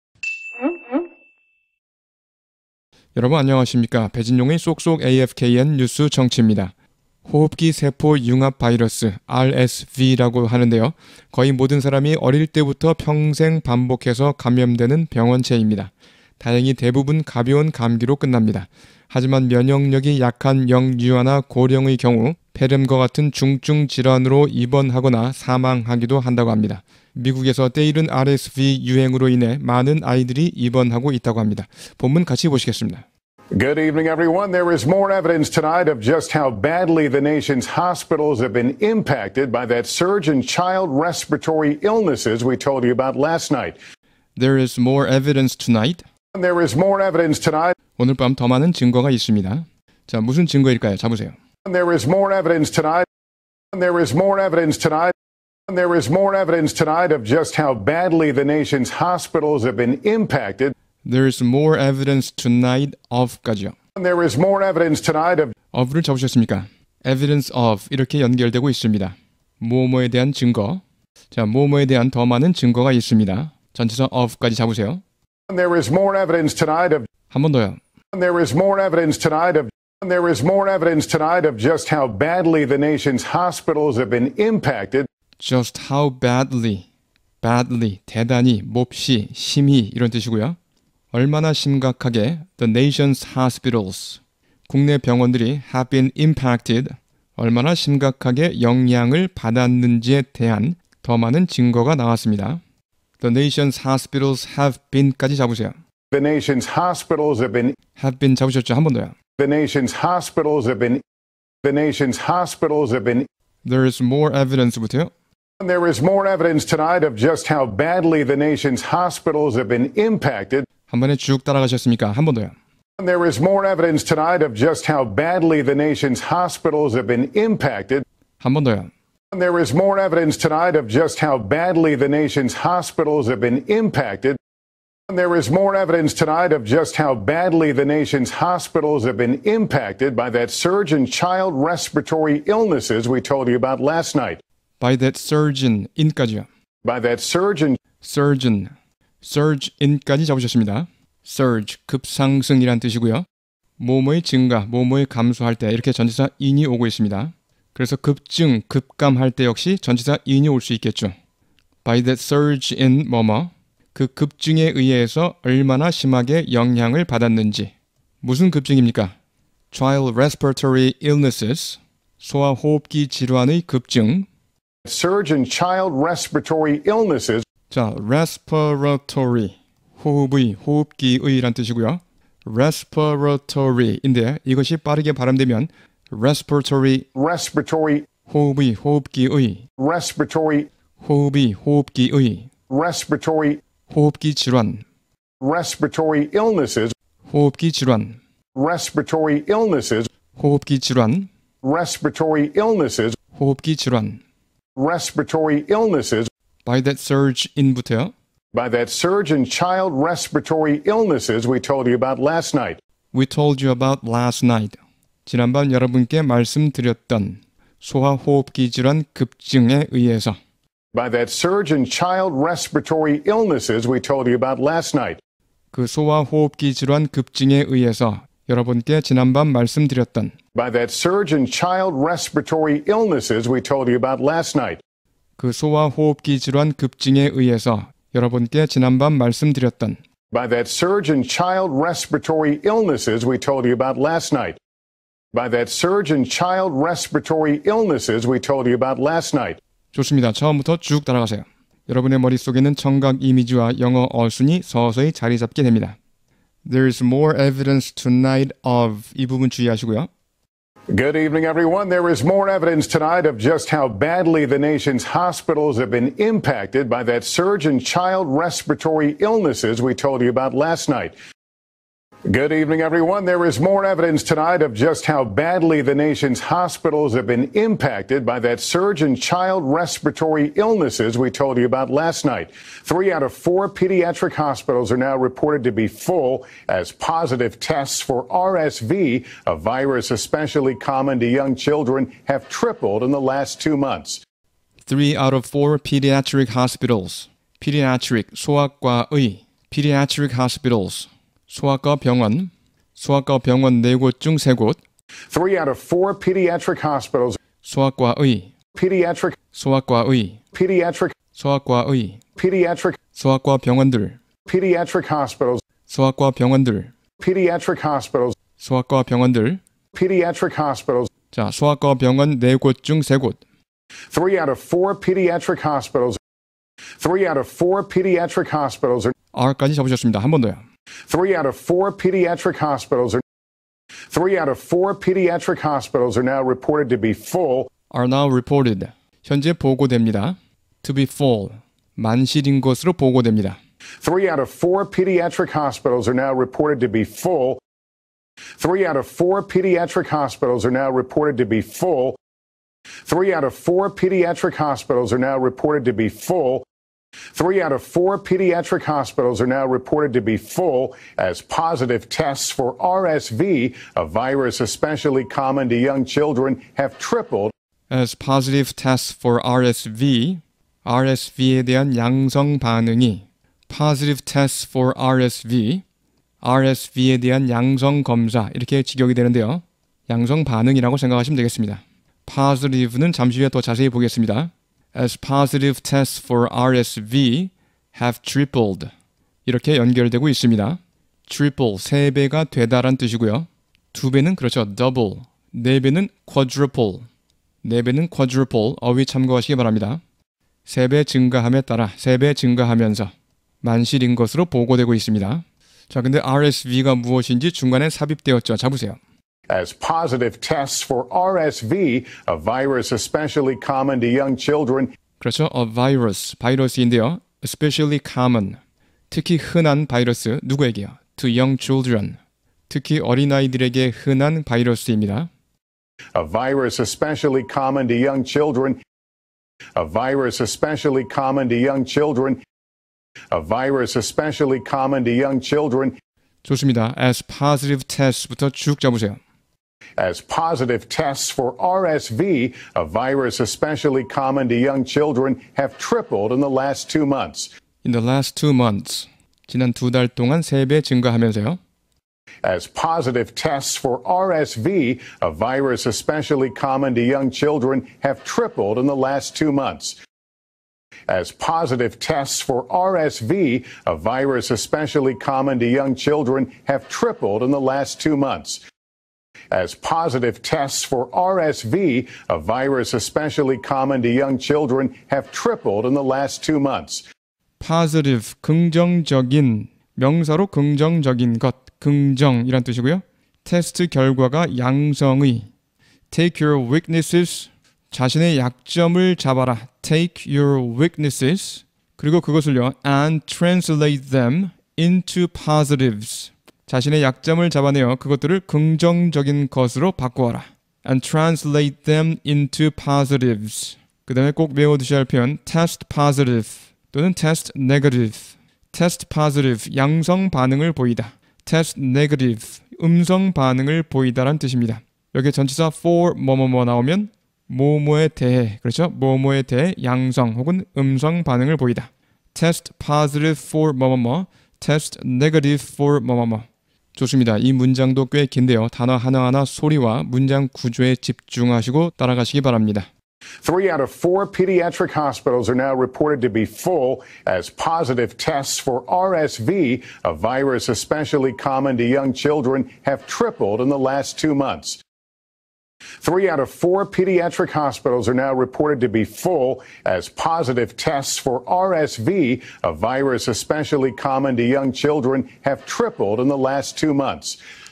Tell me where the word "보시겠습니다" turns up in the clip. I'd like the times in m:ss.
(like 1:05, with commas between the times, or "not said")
0:32.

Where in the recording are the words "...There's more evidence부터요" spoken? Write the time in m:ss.
1:53.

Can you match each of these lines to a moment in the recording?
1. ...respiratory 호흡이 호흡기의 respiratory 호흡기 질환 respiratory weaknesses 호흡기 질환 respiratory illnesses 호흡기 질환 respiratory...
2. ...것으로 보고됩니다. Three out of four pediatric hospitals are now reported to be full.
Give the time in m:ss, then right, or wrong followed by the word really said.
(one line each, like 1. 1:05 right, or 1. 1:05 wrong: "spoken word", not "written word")
1. 3:09 wrong: "illnesses", not "weaknesses"
2. 5:42 right.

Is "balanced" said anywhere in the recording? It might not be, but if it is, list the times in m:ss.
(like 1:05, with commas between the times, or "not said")
not said.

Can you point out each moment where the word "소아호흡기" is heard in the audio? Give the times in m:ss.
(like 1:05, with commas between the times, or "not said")
2:52, 3:37, 3:45.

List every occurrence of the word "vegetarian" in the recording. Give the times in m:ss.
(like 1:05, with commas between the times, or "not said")
not said.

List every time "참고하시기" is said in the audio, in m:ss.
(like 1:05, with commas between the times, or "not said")
6:39.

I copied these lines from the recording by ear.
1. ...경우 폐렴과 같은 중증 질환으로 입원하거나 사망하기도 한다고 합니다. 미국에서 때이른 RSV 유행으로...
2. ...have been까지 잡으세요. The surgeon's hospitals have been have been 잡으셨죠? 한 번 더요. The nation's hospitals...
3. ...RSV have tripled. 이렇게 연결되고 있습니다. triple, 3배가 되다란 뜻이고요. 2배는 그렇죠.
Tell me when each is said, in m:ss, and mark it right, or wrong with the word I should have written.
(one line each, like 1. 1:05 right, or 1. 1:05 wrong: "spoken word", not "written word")
1. 0:21 right
2. 1:44 wrong: "nation", not "surgeon"
3. 6:26 right.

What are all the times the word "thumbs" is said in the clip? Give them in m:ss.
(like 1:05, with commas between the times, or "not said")
not said.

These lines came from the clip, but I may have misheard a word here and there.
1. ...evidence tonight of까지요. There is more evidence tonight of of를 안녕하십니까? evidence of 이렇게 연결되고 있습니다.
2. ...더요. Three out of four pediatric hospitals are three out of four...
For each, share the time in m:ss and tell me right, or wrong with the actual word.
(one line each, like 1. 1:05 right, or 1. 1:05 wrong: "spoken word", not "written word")
1. 1:01 wrong: "잡으셨습니까", not "안녕하십니까"
2. 5:30 right.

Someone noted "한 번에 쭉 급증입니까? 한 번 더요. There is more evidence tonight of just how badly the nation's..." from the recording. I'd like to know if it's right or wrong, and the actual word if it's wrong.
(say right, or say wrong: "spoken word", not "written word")
wrong: "따라가셨습니까", not "급증입니까".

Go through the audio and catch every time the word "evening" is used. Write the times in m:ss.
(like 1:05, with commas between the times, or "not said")
0:33, 4:21, 4:32.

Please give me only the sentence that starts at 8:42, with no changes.
test positive for 뭐뭐뭐, test negative for 뭐뭐뭐.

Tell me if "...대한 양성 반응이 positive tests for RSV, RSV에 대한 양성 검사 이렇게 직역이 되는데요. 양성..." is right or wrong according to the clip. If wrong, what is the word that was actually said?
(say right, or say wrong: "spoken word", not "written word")
right.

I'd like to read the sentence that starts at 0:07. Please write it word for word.
호흡기 세포 융합 바이러스 RSV라고 하는데요.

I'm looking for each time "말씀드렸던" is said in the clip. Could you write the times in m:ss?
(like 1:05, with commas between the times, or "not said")
3:36, 3:49, 3:59.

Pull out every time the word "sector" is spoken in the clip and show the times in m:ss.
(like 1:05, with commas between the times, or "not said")
not said.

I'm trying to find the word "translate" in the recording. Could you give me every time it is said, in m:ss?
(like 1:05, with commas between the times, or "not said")
8:13, 8:21.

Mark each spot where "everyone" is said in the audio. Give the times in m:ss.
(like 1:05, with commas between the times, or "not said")
0:34, 4:21, 4:32.